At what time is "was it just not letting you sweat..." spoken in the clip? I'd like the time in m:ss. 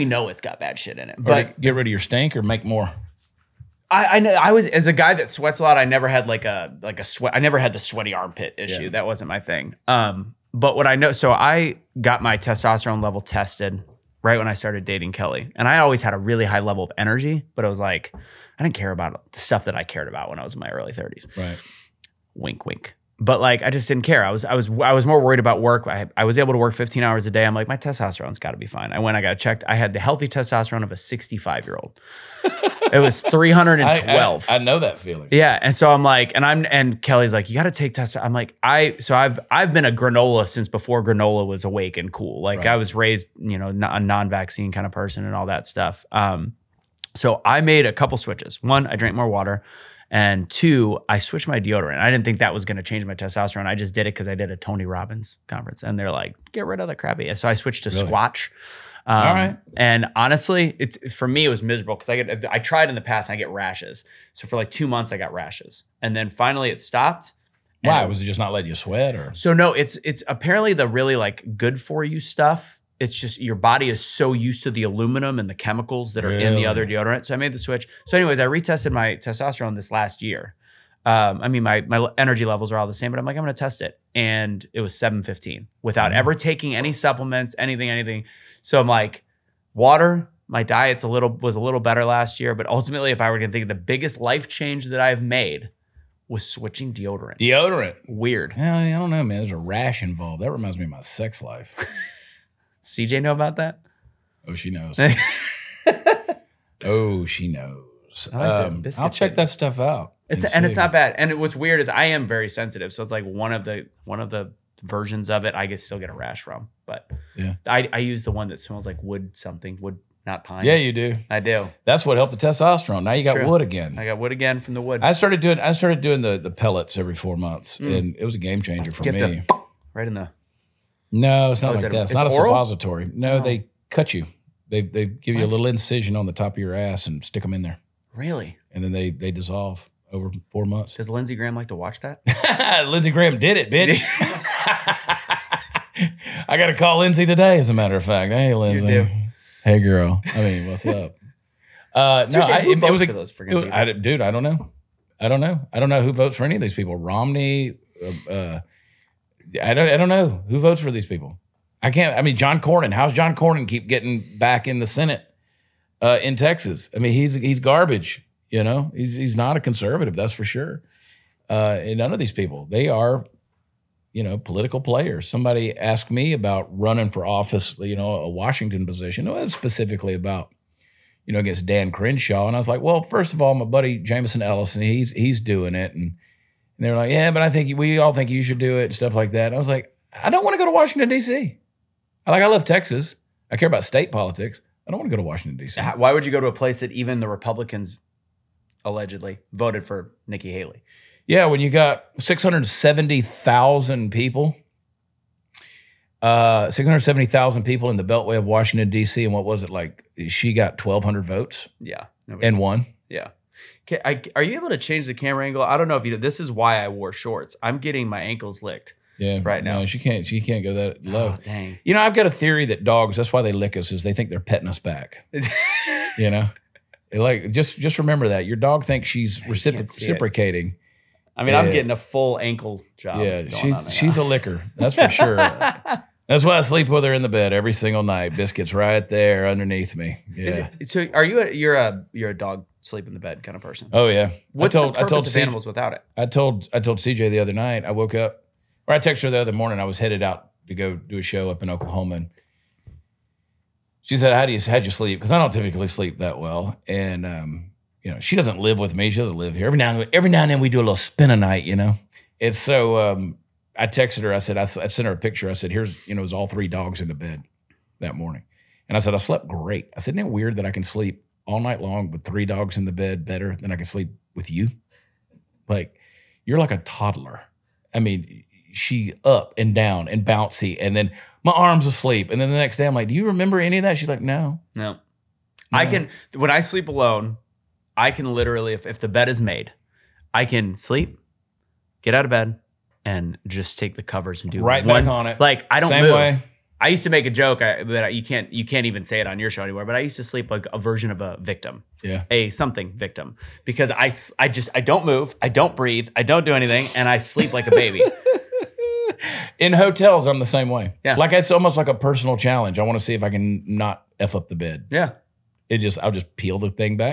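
1:08.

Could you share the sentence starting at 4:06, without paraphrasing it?
I told I told CJ the other night.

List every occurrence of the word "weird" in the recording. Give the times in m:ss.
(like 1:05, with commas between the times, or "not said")
1:38, 1:51, 4:30.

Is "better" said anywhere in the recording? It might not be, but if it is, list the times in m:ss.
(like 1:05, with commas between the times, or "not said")
1:31, 4:33.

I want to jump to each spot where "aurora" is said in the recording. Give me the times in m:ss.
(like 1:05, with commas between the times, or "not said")
not said.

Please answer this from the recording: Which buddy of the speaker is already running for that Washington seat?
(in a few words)
Jameson Ellison.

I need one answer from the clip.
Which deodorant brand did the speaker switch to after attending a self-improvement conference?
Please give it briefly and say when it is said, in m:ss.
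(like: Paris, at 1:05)
Squatch, at 0:58.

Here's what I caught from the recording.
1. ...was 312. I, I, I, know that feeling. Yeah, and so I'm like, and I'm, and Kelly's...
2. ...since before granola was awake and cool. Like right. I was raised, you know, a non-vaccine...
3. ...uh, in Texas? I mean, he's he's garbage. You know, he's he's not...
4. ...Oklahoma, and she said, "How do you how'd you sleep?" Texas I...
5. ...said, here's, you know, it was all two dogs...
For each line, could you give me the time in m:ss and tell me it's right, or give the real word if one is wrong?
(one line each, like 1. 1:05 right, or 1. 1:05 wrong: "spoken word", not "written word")
1. 0:33 right
2. 0:40 right
3. 2:46 right
4. 4:11 wrong: "Because", not "Texas"
5. 4:25 wrong: "three", not "two".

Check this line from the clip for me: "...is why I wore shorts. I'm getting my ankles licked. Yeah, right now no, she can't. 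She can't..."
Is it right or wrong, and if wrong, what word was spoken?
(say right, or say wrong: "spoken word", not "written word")
right.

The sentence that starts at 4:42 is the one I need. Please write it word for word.
And then the next day I'm like, do you remember any of that?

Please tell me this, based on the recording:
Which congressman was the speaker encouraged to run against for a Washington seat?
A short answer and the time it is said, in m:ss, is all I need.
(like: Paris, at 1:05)
Dan Crenshaw, at 3:01.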